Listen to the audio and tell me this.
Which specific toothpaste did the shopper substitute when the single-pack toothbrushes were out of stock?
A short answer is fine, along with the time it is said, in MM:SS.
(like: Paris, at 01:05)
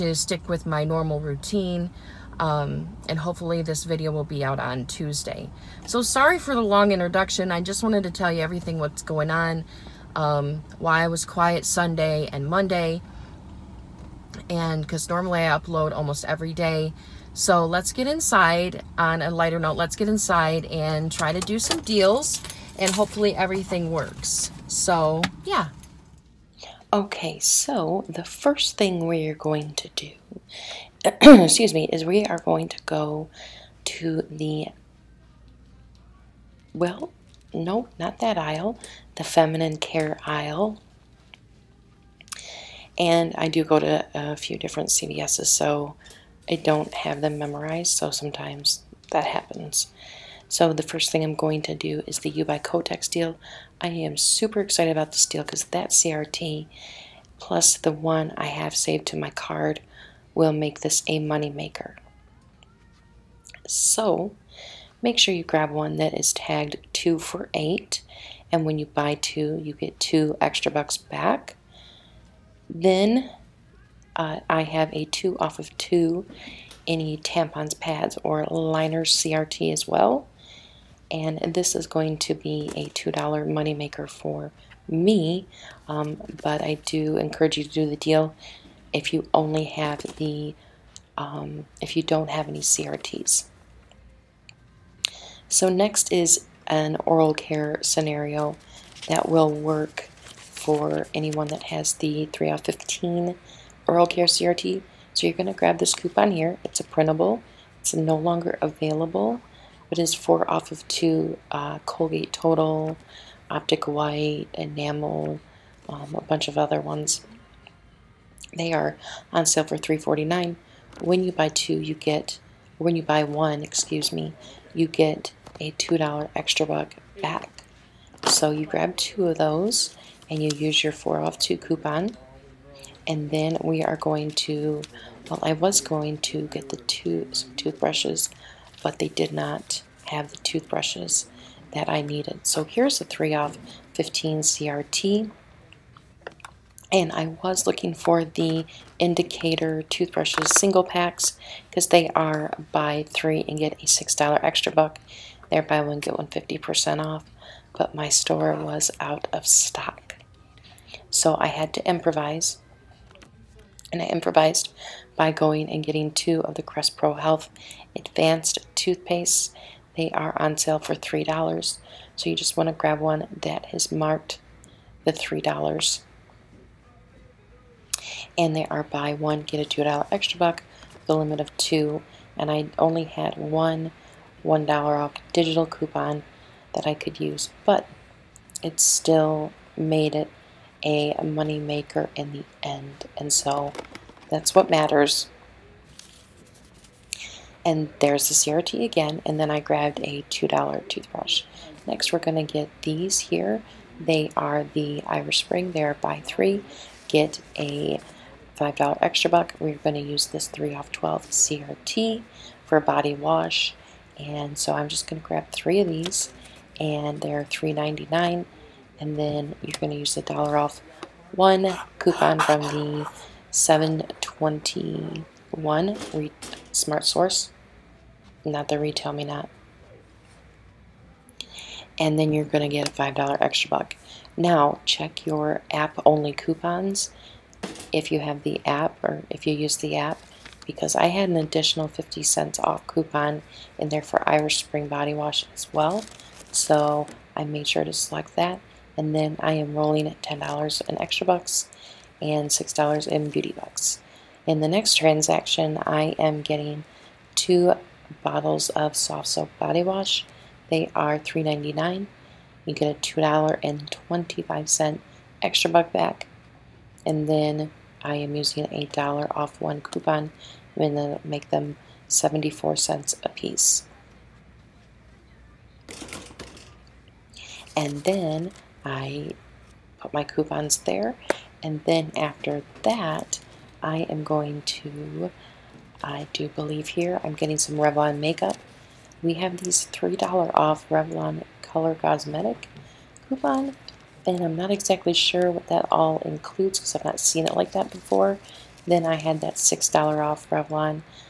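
Crest Pro Health Advanced, at 02:46.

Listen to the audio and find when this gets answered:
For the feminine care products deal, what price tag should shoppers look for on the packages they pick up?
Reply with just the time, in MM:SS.
01:06.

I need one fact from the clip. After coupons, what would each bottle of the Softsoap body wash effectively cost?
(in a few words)
74 cents.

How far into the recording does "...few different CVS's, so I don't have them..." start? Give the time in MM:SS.
00:44.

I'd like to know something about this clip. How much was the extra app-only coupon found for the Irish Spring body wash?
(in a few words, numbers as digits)
50 cents.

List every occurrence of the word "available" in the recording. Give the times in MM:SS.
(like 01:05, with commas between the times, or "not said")
01:48.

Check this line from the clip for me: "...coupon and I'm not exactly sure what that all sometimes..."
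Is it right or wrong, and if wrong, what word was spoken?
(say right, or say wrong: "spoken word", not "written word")
wrong: "includes", not "sometimes".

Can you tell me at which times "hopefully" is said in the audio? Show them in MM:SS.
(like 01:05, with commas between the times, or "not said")
00:03, 00:22.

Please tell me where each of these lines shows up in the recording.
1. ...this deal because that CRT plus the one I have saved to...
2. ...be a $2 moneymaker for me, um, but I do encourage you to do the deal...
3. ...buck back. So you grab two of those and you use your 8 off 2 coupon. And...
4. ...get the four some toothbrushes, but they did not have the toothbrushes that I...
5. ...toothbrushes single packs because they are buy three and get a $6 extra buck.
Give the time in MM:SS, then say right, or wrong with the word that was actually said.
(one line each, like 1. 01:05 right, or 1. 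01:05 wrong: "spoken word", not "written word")
1. 00:55 right
2. 01:22 right
3. 02:06 wrong: "4", not "8"
4. 02:16 wrong: "two", not "four"
5. 02:29 right.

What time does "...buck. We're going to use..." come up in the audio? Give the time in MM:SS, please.
03:29.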